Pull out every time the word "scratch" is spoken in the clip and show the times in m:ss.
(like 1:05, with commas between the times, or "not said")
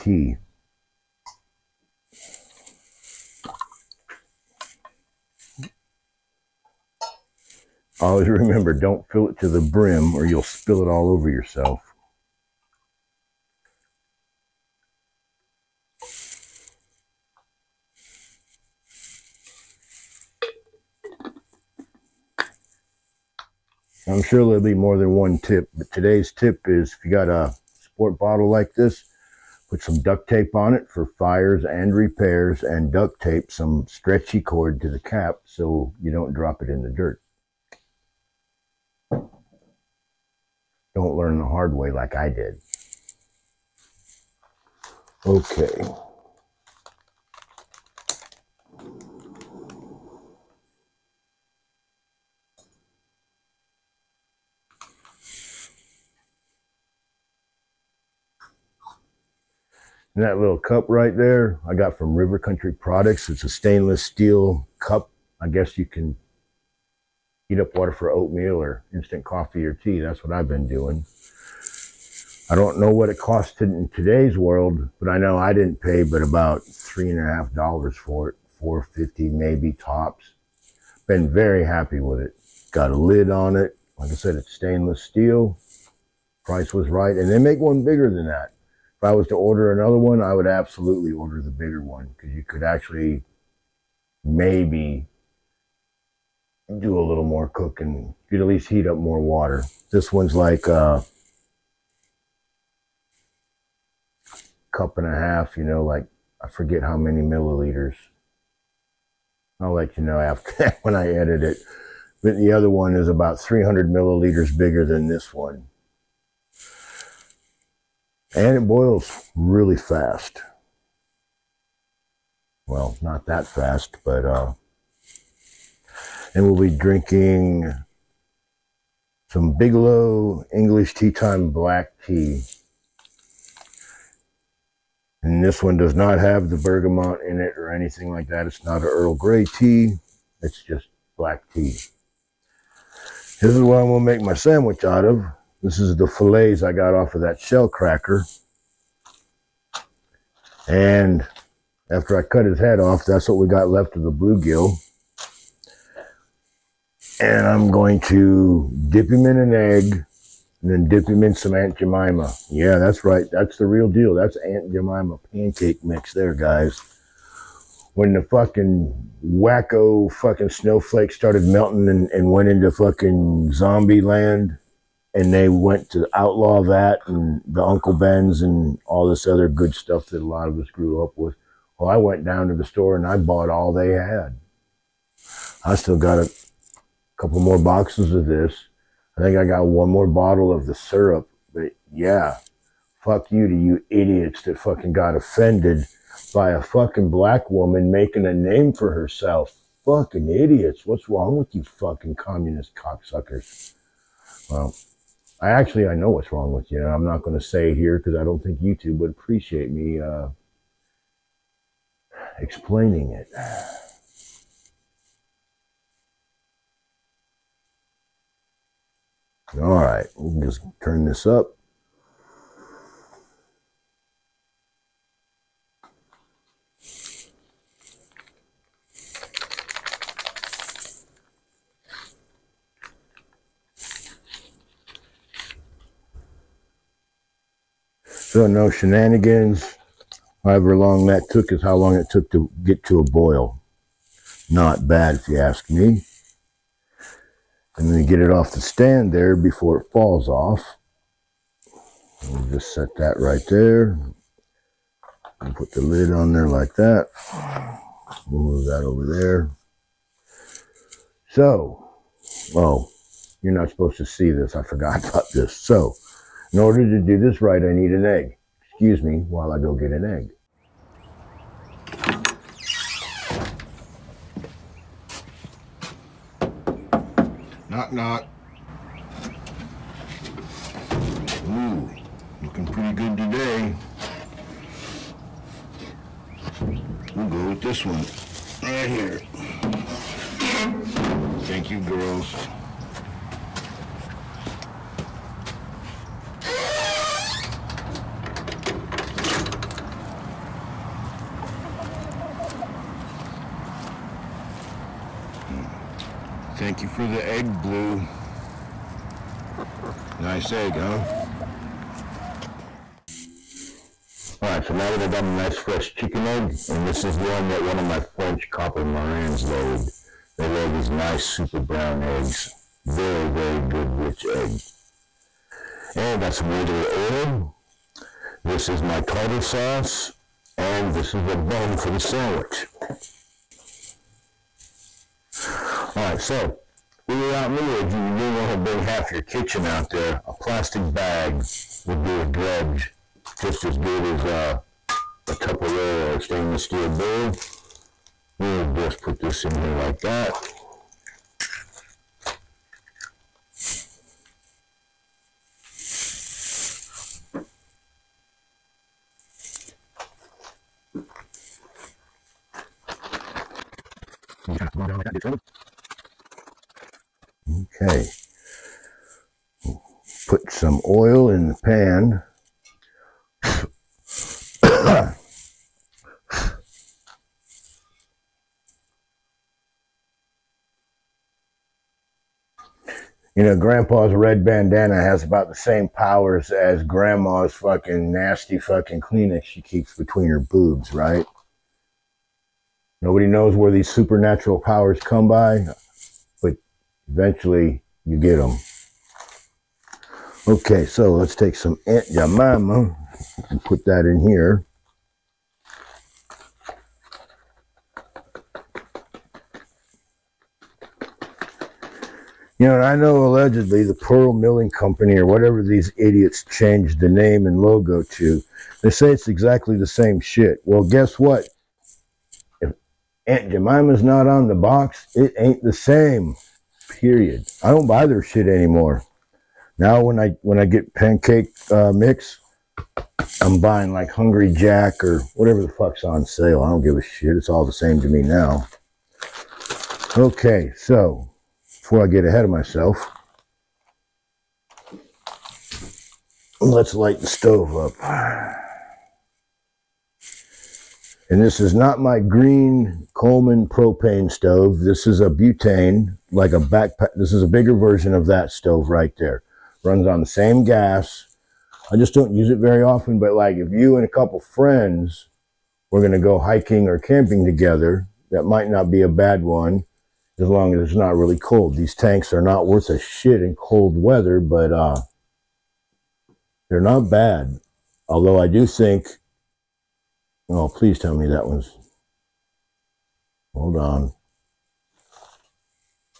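not said.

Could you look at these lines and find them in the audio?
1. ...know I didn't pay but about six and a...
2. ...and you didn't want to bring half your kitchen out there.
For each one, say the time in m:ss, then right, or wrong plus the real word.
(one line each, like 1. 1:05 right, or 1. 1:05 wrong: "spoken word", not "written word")
1. 1:15 wrong: "three", not "six"
2. 5:37 right.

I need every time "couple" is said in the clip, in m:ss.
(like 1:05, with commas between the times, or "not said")
3:07, 7:44.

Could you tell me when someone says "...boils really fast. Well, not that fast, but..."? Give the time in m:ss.
1:58.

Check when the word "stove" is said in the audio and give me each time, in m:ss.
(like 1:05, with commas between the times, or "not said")
7:27, 7:34, 7:38.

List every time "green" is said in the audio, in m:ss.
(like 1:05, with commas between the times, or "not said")
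7:32.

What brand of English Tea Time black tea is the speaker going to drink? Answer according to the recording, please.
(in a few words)
Bigelow.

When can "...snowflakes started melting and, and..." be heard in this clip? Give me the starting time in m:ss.
2:50.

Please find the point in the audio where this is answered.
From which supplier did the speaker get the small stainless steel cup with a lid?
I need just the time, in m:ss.
1:02.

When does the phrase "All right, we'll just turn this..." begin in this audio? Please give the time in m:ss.
3:39.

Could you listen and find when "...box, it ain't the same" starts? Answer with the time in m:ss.
7:04.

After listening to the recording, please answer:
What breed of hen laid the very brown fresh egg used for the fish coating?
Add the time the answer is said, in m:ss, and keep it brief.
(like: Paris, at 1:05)
French copper Marans, at 5:17.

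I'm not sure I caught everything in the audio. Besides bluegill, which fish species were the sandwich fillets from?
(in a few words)
Shell cracker.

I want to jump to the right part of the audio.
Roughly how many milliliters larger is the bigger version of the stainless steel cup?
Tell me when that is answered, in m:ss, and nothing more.
1:53.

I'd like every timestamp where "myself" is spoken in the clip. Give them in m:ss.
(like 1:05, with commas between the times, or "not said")
7:22.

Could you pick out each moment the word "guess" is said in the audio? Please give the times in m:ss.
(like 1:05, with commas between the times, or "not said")
1:05, 7:00.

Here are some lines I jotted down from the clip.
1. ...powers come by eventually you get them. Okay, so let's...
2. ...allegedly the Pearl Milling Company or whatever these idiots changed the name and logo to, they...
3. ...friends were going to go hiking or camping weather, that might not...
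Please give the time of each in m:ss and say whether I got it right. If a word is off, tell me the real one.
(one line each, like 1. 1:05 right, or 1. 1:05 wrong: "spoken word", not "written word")
1. 6:34 right
2. 6:53 right
3. 7:44 wrong: "together", not "weather".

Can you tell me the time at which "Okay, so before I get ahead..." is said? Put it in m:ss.
7:20.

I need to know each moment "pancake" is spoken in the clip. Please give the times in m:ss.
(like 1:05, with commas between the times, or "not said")
2:45, 7:10.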